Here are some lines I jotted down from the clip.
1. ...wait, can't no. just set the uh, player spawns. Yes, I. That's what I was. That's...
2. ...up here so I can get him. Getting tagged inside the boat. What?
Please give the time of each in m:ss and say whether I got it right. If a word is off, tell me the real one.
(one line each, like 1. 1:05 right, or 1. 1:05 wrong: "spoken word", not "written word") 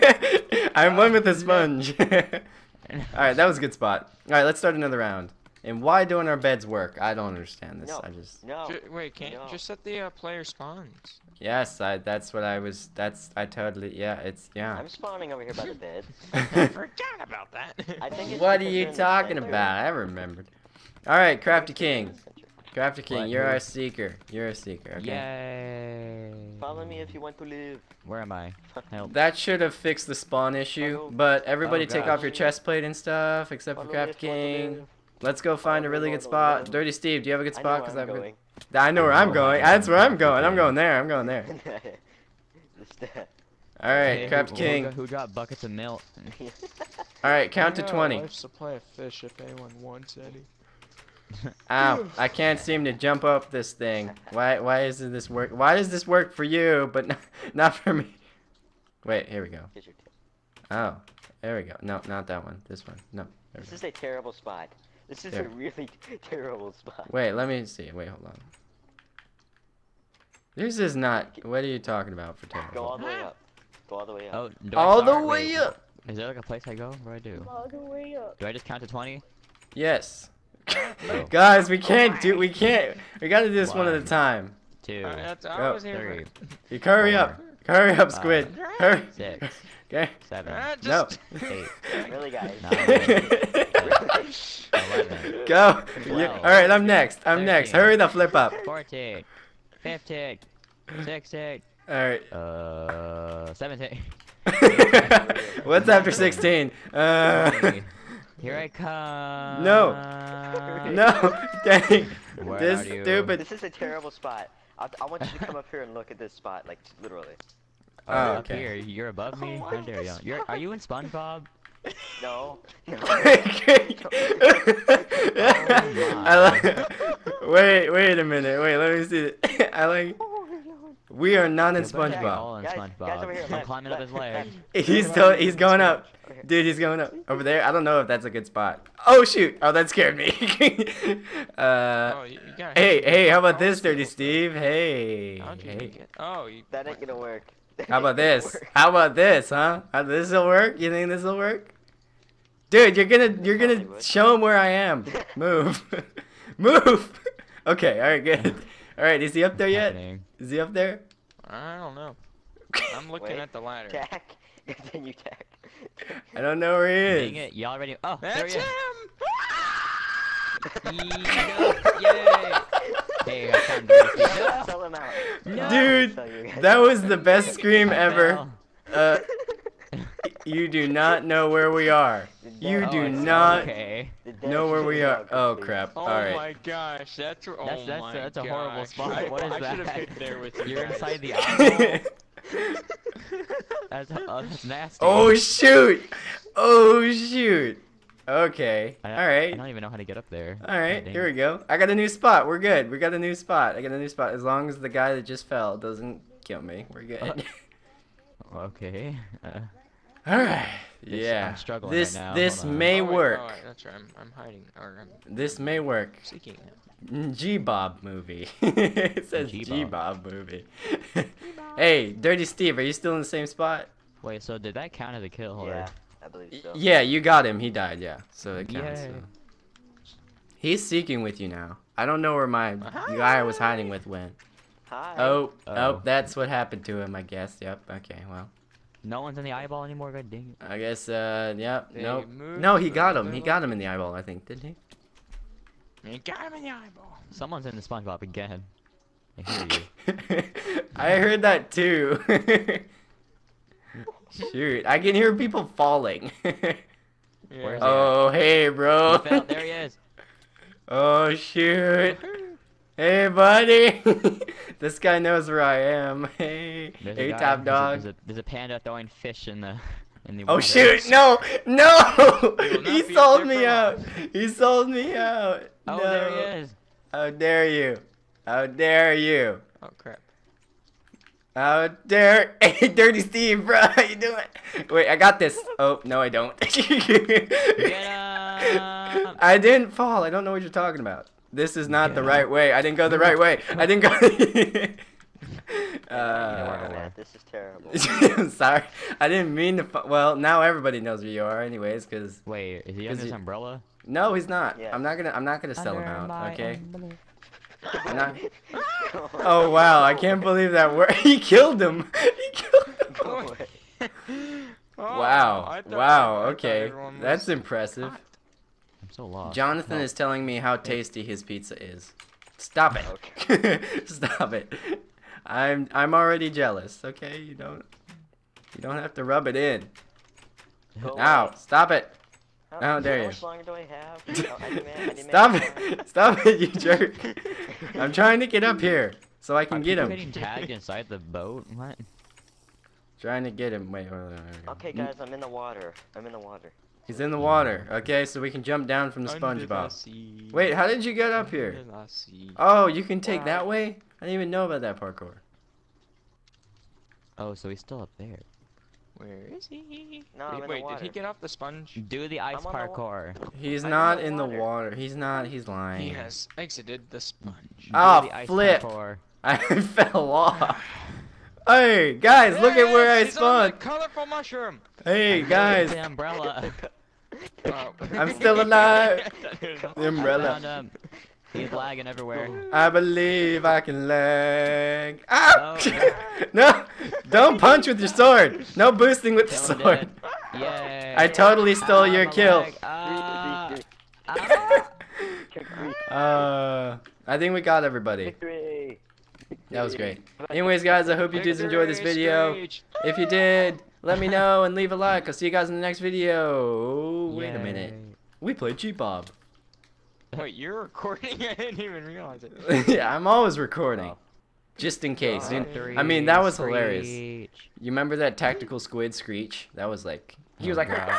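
1. 0:08 right
2. 5:38 right.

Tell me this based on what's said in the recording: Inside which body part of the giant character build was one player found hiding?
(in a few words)
the eye.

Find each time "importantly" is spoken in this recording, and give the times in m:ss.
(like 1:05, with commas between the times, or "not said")
not said.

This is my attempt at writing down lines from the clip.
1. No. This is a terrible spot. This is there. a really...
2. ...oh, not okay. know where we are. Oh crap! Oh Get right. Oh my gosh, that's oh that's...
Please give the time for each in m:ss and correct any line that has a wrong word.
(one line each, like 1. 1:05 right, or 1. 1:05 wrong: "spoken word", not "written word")
1. 1:03 right
2. 3:03 wrong: "All", not "Get".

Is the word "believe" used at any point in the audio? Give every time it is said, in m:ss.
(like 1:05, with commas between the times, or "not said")
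3:46, 5:10, 6:22.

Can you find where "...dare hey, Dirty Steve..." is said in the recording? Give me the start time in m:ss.
4:42.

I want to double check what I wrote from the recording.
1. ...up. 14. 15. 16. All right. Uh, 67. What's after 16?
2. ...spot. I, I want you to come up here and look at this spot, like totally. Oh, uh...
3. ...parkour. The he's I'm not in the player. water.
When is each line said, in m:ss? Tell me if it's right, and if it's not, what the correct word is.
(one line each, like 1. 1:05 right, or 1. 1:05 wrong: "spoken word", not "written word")
1. 1:38 wrong: "17", not "67"
2. 1:54 wrong: "literally", not "totally"
3. 6:02 wrong: "water", not "player".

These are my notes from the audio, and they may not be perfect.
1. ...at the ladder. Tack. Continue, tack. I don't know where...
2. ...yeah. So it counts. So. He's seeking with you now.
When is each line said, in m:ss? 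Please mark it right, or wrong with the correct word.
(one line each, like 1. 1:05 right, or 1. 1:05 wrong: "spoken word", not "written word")
1. 2:43 right
2. 3:47 right.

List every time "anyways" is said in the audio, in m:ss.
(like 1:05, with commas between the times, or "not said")
5:01, 6:40.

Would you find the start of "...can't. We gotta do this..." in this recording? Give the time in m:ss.
1:22.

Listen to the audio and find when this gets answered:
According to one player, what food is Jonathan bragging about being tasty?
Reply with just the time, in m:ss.
5:21.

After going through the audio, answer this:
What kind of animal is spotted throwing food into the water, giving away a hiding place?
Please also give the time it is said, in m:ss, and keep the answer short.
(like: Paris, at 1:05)
panda, at 4:28.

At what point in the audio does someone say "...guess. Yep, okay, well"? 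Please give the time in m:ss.
3:57.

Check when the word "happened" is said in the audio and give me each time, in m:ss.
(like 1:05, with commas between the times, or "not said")
3:56.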